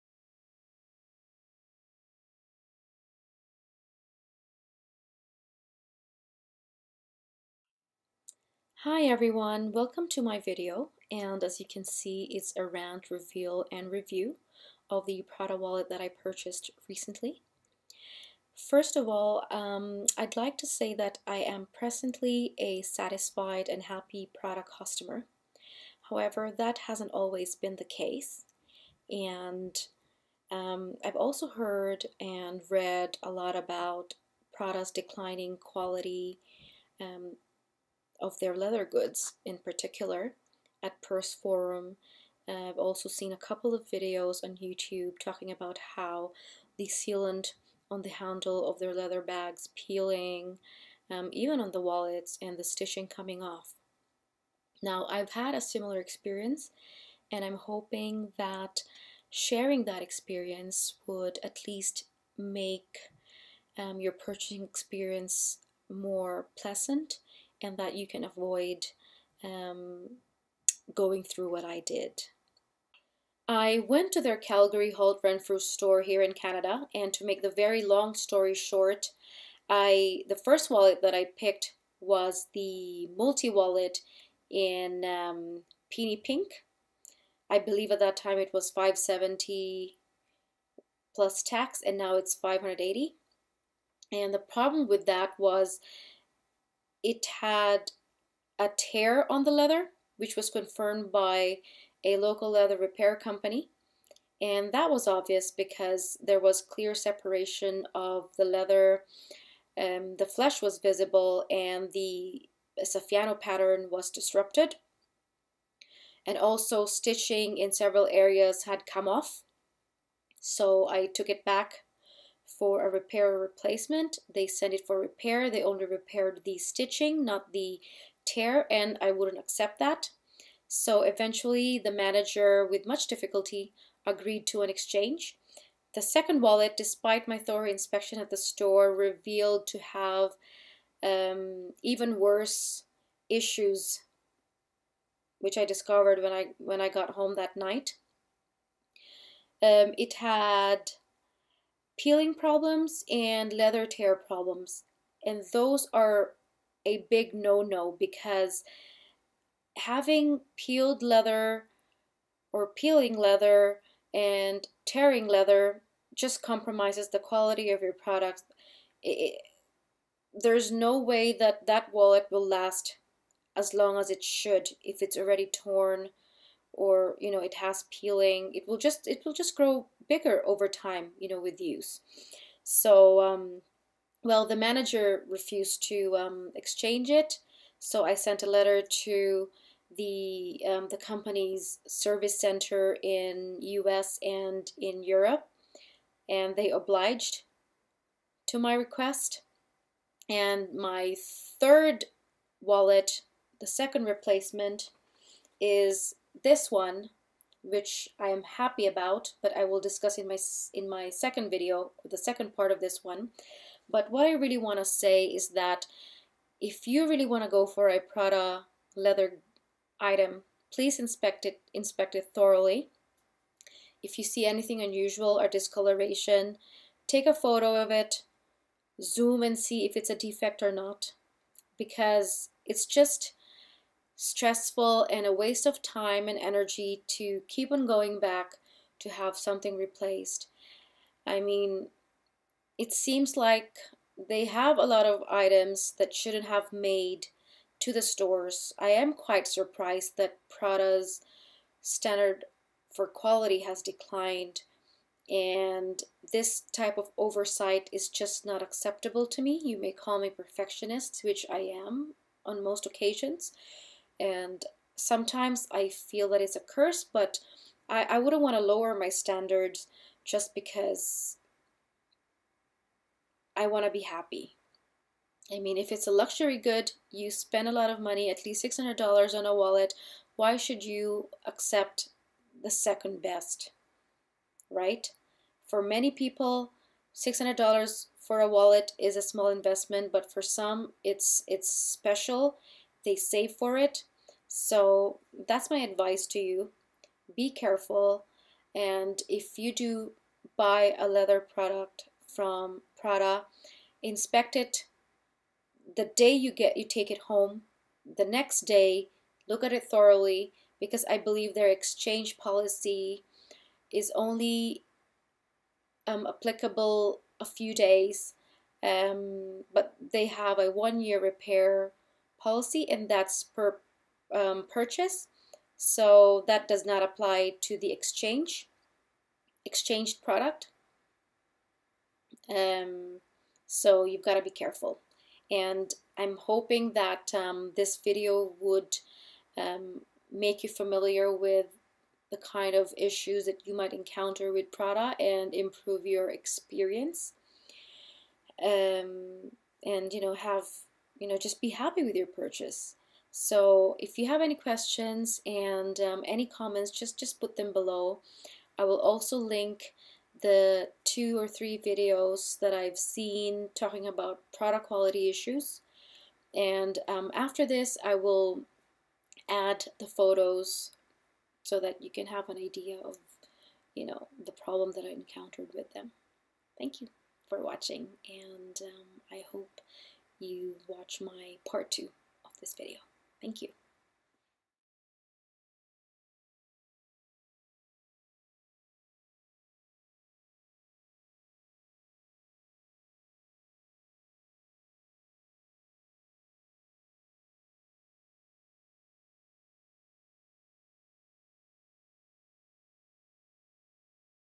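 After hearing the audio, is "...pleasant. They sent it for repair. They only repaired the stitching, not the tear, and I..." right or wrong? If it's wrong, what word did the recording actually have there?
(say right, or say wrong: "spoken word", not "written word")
wrong: "replacement", not "pleasant".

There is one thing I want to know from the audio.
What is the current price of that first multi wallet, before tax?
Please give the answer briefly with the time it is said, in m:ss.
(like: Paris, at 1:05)
580, at 1:32.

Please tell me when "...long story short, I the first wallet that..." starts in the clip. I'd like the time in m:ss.
1:17.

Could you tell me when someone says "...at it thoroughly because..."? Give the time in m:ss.
5:09.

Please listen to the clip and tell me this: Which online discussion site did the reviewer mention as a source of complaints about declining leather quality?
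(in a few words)
Purse Forum.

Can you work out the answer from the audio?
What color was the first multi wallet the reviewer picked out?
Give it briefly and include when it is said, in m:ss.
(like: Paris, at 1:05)
Peony Pink, at 1:25.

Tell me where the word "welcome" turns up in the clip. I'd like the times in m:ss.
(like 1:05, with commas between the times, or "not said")
0:09.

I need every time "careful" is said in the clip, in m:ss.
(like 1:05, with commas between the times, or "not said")
4:57, 5:34.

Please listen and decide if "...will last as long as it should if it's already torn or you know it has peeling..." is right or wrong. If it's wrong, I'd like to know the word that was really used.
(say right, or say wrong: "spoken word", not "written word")
right.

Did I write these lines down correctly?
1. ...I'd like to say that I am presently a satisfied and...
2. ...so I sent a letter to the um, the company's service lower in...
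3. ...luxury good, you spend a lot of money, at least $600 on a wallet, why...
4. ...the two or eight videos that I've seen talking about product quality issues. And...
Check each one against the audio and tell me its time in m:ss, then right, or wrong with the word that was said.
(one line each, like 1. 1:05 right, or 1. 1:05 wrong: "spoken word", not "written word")
1. 0:20 right
2. 3:07 wrong: "center", not "lower"
3. 4:36 right
4. 6:00 wrong: "three", not "eight".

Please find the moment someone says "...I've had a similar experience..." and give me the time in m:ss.
0:55.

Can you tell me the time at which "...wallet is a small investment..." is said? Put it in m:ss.
4:48.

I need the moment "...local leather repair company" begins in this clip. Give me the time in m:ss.
1:42.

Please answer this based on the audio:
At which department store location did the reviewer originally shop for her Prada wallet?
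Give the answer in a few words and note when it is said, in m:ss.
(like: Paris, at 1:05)
Calgary Holt Renfrew, at 1:14.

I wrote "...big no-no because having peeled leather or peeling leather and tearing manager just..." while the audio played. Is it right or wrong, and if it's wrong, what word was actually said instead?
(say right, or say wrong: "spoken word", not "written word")
wrong: "leather", not "manager".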